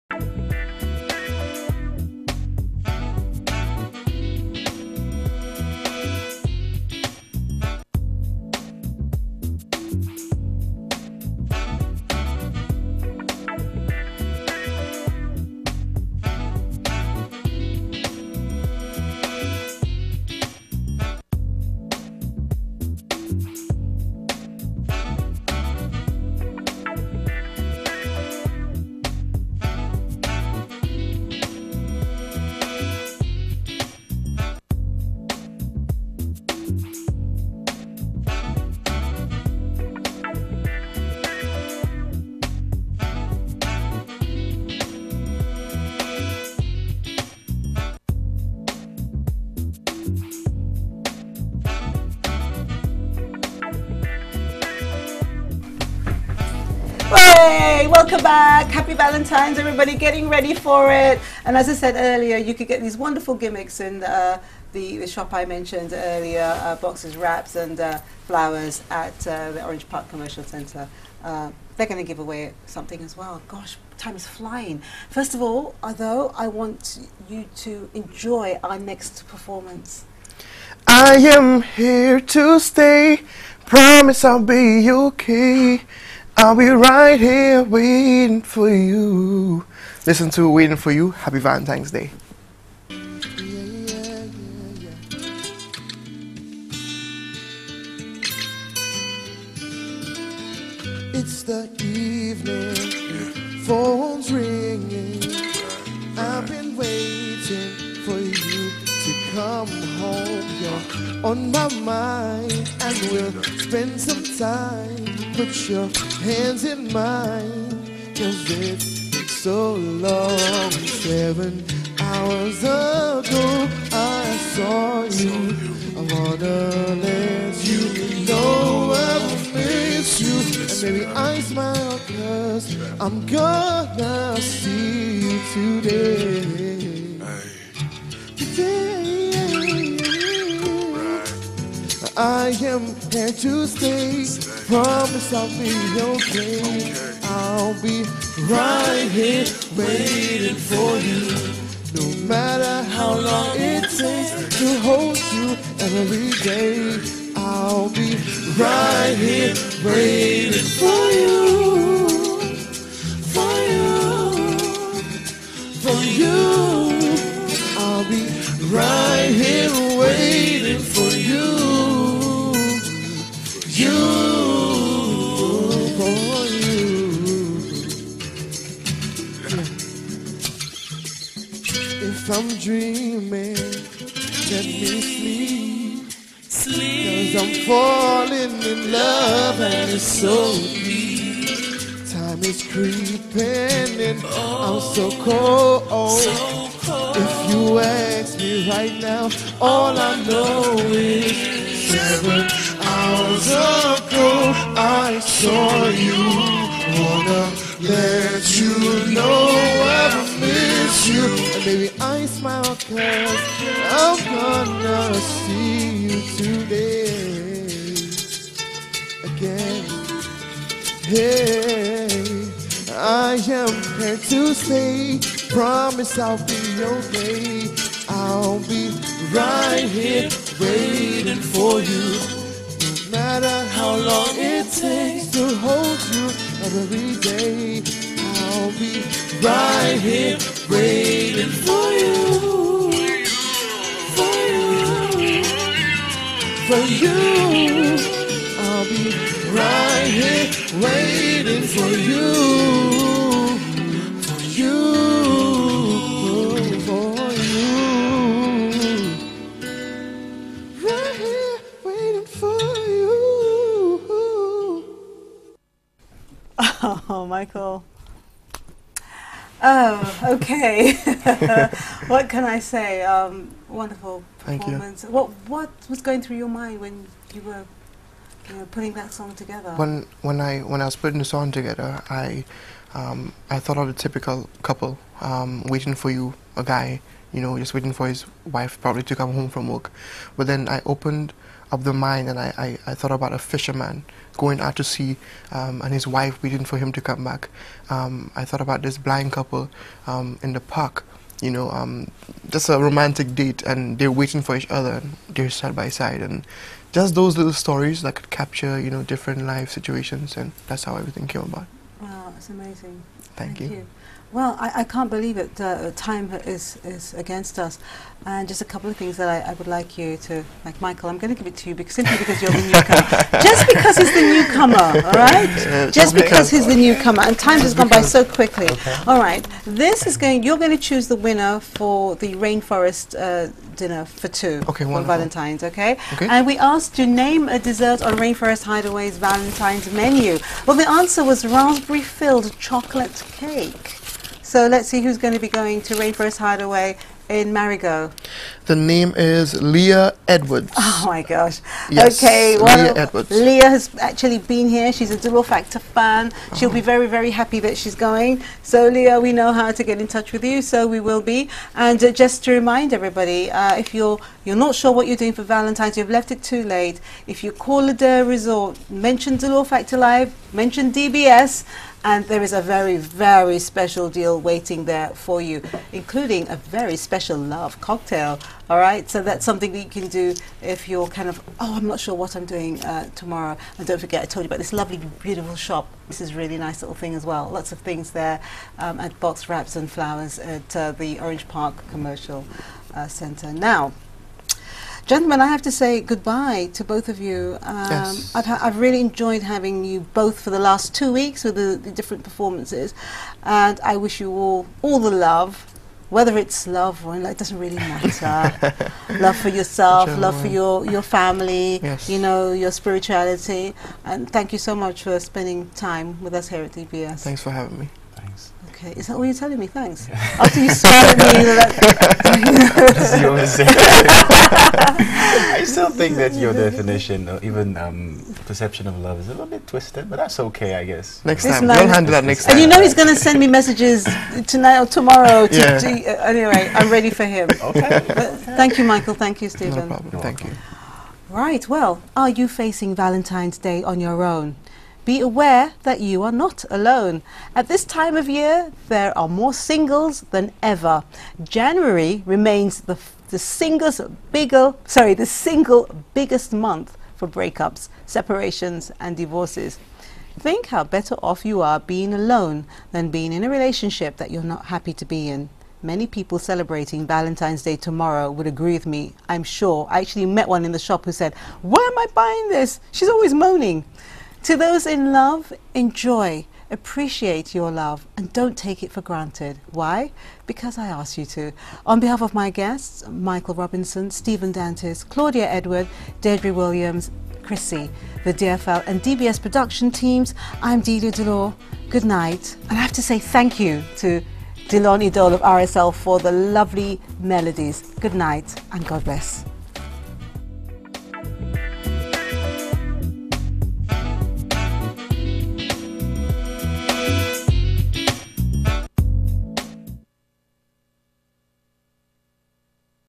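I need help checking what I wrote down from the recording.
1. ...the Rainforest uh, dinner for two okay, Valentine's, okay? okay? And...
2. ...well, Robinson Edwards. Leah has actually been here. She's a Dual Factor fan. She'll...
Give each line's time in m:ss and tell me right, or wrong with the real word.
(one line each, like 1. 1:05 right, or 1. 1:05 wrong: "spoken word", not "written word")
1. 5:32 right
2. 5:52 wrong: "Leah", not "Robinson".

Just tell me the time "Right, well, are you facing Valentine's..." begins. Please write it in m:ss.
7:21.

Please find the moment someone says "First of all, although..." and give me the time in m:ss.
1:15.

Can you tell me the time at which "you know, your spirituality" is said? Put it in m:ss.
6:52.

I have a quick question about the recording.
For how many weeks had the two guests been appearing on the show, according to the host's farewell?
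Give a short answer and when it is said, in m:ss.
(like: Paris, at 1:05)
2, at 6:40.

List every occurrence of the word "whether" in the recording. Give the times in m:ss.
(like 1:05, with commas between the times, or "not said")
6:46.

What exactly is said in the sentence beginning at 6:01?
And uh, just to remind everybody, uh, if you're you're not sure what you're doing for Valentine's, you've left it too late.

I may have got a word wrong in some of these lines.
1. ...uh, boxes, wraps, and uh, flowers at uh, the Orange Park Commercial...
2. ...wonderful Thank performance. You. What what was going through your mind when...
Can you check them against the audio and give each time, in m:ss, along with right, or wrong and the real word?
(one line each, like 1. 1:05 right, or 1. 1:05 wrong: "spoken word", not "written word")
1. 1:06 right
2. 4:33 right.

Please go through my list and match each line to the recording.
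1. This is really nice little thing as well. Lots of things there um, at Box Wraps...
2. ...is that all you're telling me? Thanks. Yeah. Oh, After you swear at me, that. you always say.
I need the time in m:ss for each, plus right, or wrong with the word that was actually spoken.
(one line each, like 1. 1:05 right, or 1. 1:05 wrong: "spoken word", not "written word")
1. 6:26 right
2. 6:58 right.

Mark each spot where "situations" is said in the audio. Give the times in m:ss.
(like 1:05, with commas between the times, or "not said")
5:09.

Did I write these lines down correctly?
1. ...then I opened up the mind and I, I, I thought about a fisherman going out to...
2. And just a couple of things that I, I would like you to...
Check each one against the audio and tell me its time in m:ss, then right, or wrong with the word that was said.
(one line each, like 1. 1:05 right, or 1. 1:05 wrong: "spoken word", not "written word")
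1. 4:50 right
2. 5:18 right.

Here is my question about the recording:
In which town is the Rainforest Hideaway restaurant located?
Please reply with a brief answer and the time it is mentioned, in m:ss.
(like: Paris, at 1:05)
Marigot, at 5:47.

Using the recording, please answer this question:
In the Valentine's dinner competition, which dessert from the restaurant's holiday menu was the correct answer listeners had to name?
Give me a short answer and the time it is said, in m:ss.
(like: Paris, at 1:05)
Raspberry filled chocolate cake, at 5:41.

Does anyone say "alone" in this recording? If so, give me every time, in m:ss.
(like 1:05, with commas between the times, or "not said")
7:26, 7:42.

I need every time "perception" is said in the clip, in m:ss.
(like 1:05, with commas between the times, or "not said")
7:08.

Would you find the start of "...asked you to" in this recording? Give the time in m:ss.
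8:00.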